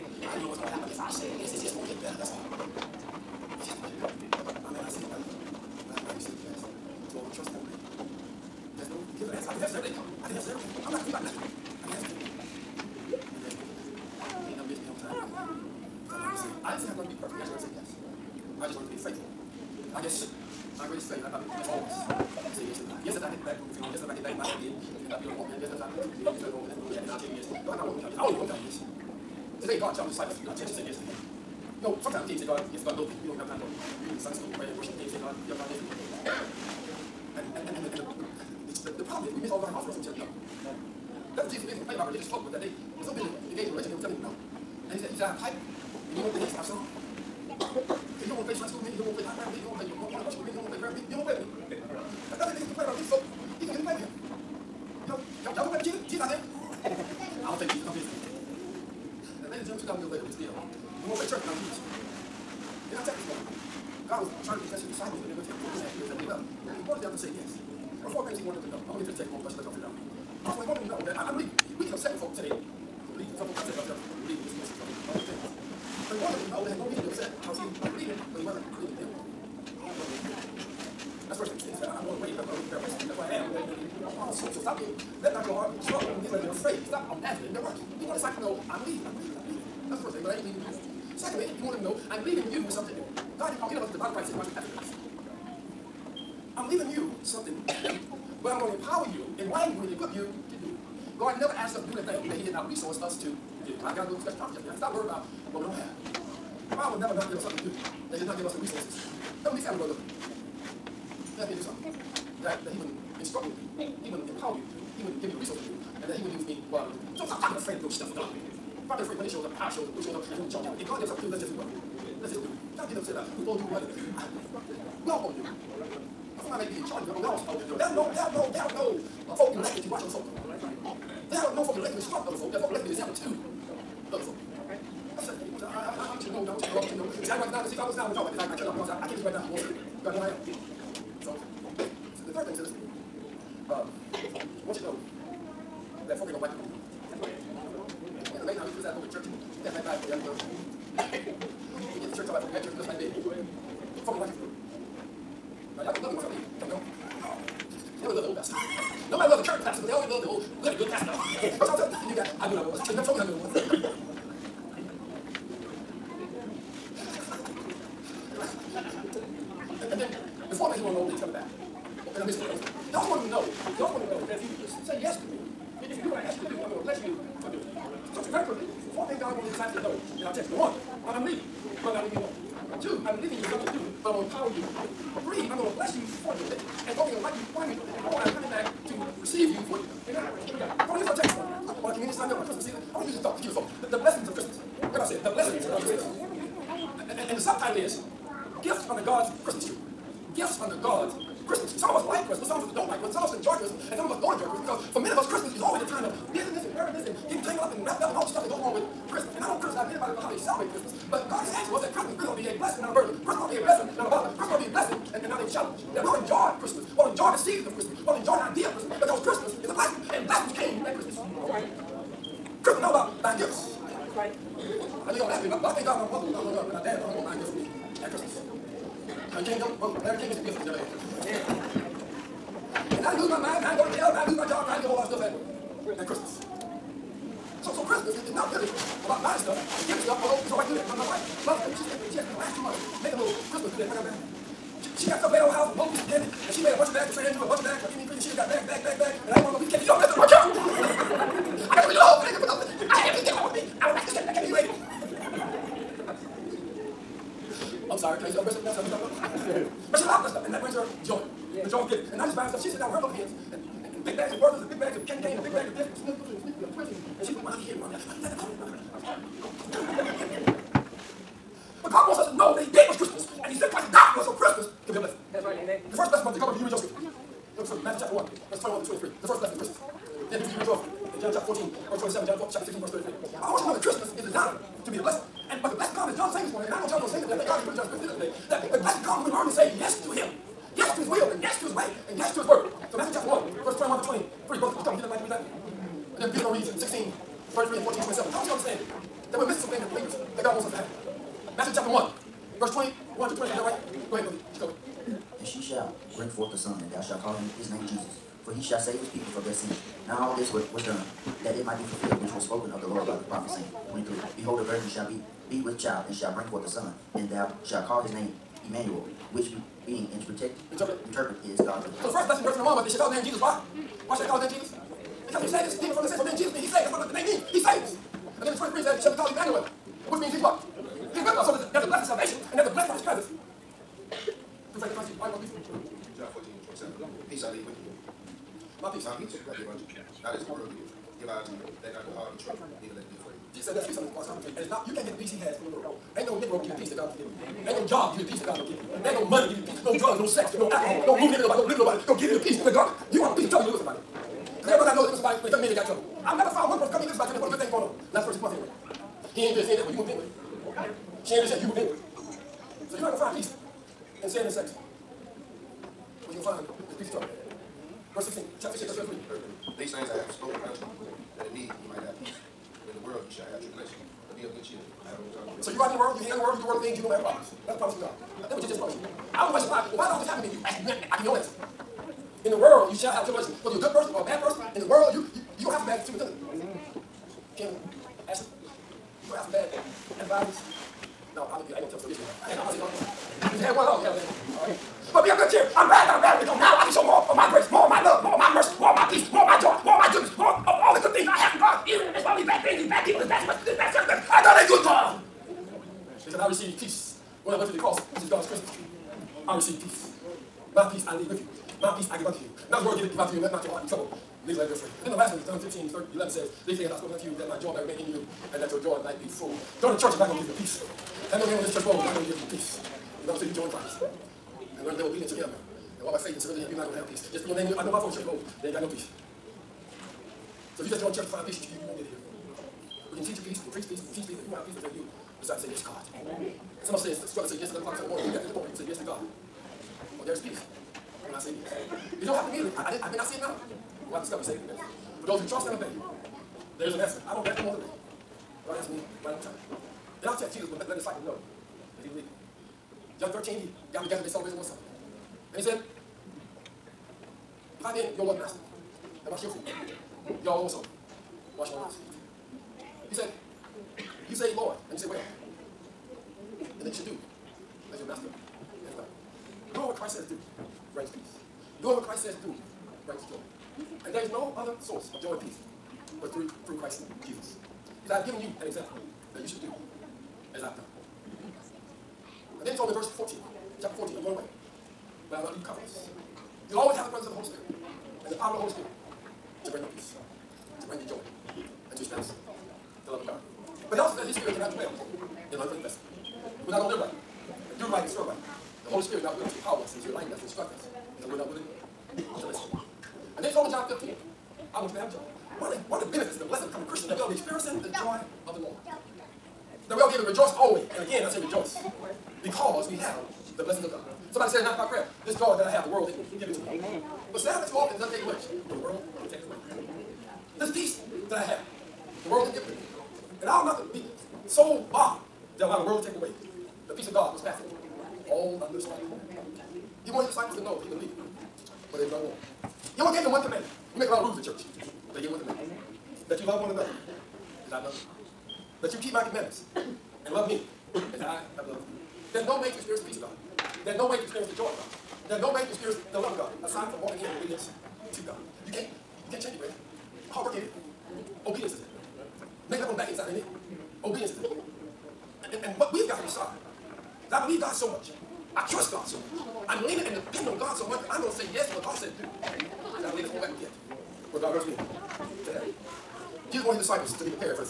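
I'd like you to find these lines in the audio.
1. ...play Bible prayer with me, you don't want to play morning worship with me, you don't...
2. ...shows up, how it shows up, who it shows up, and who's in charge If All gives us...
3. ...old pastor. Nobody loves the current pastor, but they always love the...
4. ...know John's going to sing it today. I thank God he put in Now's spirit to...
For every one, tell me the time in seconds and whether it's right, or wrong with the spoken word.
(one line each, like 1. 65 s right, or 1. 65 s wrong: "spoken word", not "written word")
1. 49 s right
2. 119 s wrong: "God", not "All"
3. 158 s right
4. 286 s wrong: "John", not "Now".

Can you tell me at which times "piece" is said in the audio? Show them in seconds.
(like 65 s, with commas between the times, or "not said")
353 s, 366 s.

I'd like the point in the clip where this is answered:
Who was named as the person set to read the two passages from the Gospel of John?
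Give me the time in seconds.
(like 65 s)
296 s.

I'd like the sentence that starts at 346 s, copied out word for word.
Ain't no Negro can give you peace that God will give you.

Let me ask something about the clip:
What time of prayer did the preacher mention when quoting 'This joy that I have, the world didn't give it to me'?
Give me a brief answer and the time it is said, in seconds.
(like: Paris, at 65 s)
9 o'clock prayer, at 514 s.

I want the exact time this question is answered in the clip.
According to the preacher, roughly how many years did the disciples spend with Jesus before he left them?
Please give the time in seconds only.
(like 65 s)
65 s.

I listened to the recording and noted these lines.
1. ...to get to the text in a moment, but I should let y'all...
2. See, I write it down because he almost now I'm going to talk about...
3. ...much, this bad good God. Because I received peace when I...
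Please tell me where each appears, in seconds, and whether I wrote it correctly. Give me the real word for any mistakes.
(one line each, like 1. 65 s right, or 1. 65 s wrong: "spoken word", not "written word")
1. 68 s right
2. 135 s right
3. 403 s right.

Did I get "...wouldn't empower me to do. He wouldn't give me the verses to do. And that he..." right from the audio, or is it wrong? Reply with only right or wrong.
wrong.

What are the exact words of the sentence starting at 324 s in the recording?
Why should they call his name Jesus?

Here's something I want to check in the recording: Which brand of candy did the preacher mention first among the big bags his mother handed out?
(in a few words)
Werther's.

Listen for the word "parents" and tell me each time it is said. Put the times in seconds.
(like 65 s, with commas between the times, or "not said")
not said.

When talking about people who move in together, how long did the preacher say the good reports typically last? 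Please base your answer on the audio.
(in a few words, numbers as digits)
6 months.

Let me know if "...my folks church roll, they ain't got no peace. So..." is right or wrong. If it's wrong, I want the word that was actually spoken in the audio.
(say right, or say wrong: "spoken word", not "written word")
right.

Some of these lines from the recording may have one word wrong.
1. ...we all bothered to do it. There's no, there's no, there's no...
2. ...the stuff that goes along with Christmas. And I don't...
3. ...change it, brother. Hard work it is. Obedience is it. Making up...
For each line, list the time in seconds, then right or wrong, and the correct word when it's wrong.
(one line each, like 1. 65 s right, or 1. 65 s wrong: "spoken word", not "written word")
1. 127 s wrong: "supposed", not "bothered"
2. 208 s right
3. 549 s right.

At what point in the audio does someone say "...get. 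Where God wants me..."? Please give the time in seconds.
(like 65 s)
563 s.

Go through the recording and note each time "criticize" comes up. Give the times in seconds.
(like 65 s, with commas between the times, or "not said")
148 s, 209 s.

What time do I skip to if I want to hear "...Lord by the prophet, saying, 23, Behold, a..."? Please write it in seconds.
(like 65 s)
312 s.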